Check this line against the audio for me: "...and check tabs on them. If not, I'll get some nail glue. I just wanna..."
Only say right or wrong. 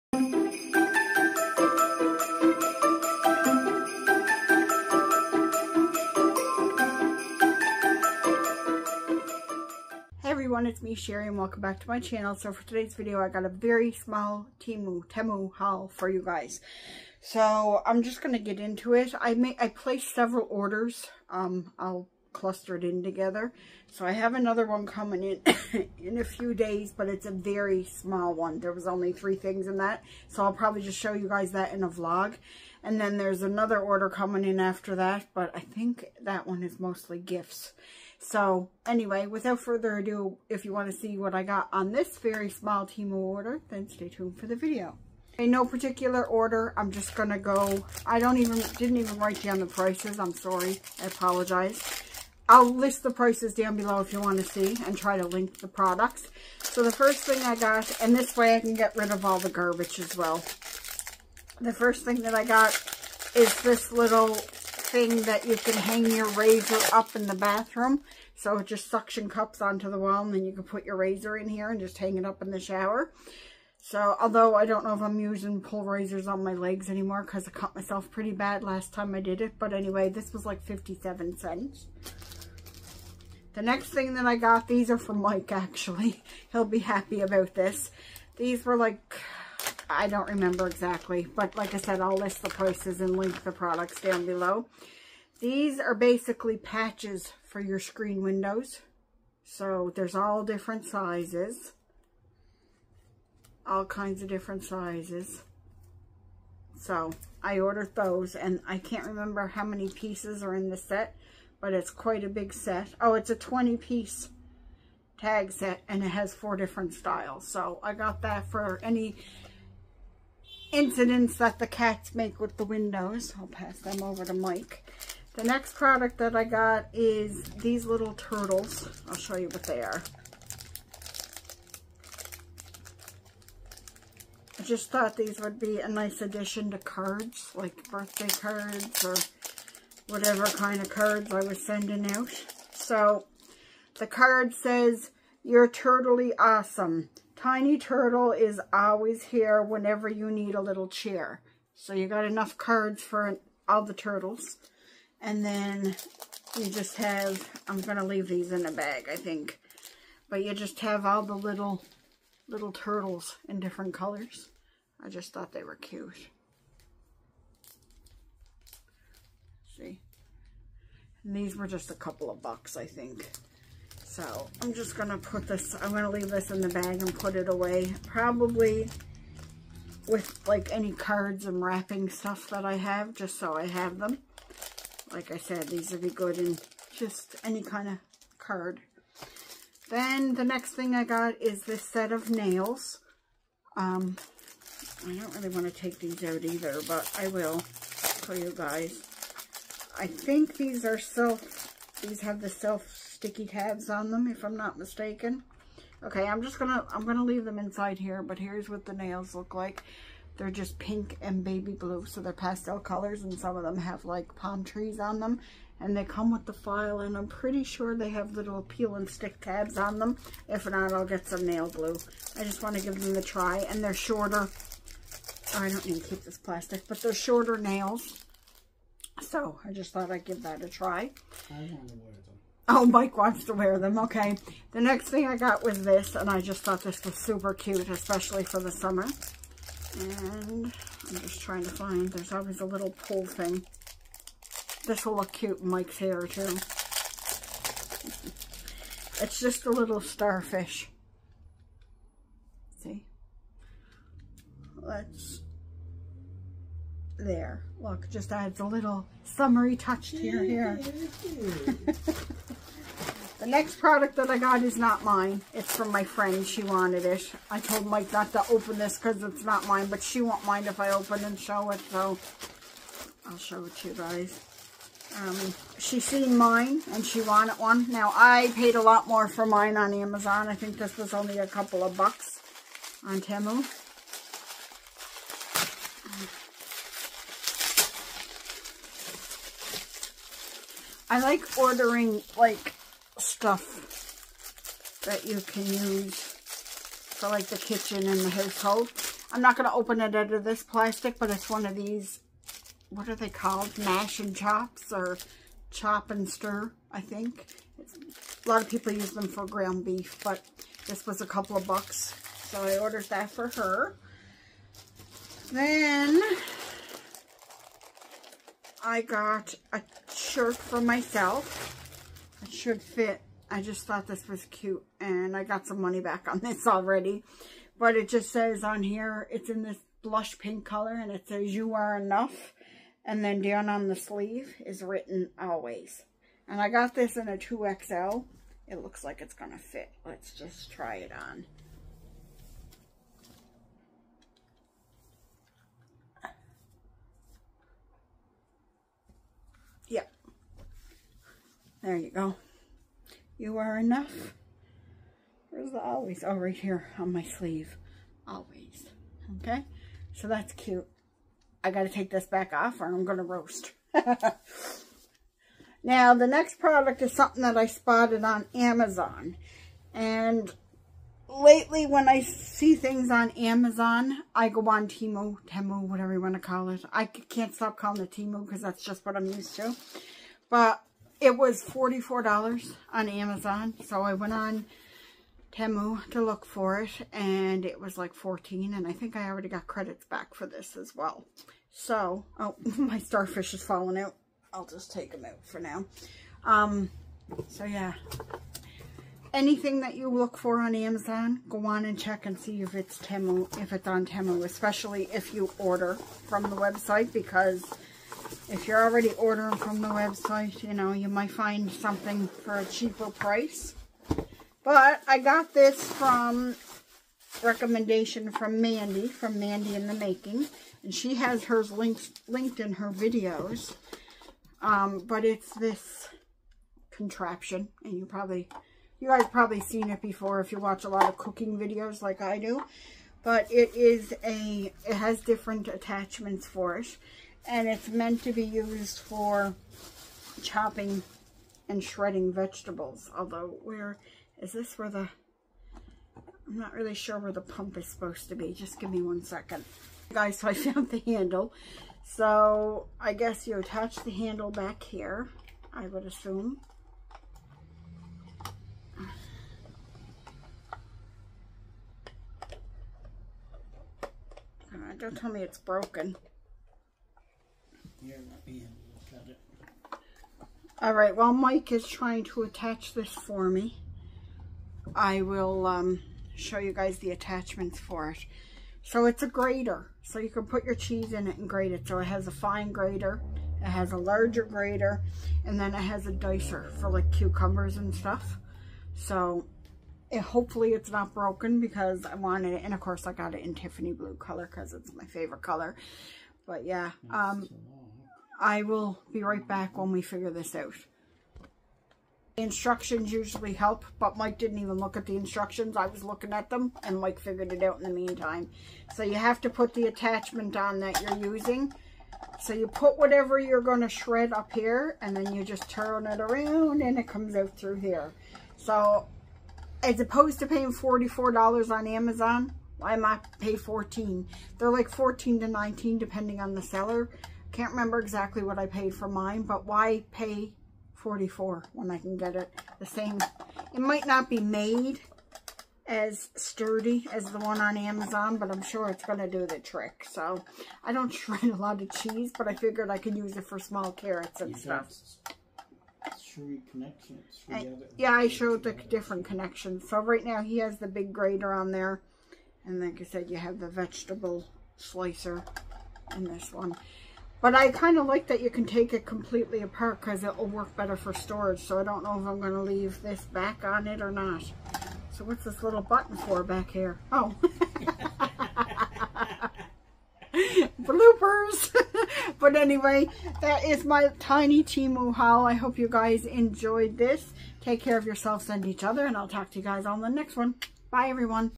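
wrong.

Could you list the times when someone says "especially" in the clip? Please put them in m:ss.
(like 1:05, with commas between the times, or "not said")
3:57, 6:44.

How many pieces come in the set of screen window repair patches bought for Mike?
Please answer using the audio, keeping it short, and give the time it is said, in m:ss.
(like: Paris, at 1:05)
20, at 1:53.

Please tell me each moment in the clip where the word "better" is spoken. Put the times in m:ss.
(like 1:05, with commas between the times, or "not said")
9:20.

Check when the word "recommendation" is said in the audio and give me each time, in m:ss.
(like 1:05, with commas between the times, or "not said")
6:57.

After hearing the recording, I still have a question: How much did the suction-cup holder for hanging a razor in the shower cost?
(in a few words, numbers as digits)
57 cents.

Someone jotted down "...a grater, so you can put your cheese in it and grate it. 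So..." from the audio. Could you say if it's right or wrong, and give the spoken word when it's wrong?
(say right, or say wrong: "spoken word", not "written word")
right.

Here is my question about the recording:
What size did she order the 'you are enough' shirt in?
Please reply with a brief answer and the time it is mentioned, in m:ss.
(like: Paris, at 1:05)
2XL, at 5:37.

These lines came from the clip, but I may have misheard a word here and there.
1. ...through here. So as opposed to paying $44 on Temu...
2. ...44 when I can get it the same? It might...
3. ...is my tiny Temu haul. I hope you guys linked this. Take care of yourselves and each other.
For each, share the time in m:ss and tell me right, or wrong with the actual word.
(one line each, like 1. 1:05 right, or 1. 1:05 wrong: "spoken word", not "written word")
1. 8:37 wrong: "Amazon", not "Temu"
2. 8:50 right
3. 9:33 wrong: "enjoyed", not "linked".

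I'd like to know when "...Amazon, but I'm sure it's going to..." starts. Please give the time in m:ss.
8:57.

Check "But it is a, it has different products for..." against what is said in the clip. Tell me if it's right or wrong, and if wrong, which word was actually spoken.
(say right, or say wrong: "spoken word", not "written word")
wrong: "attachments", not "products".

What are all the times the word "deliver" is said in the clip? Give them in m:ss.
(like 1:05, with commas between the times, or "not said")
not said.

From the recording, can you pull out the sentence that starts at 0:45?
In no particular order, I'm just going to go, I don't even, didn't even write down the prices, I'm sorry, I apologize.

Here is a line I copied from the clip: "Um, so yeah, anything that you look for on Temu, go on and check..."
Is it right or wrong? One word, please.
wrong.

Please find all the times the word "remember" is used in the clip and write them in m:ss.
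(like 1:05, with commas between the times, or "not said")
1:30, 1:49, 8:47.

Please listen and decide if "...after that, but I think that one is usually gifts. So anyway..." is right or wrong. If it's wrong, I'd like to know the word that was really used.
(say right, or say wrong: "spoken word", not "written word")
wrong: "mostly", not "usually".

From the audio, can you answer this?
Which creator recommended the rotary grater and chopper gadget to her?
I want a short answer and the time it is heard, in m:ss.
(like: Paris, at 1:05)
Mandy in the Making, at 6:59.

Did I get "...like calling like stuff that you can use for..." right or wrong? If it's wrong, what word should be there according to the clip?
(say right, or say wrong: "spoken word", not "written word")
wrong: "ordering", not "calling".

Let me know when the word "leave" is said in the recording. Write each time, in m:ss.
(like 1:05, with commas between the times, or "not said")
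2:38, 2:56, 3:27, 9:22.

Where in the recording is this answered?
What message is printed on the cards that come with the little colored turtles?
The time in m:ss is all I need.
2:25.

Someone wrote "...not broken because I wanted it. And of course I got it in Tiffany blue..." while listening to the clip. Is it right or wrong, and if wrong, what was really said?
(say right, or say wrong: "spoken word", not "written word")
right.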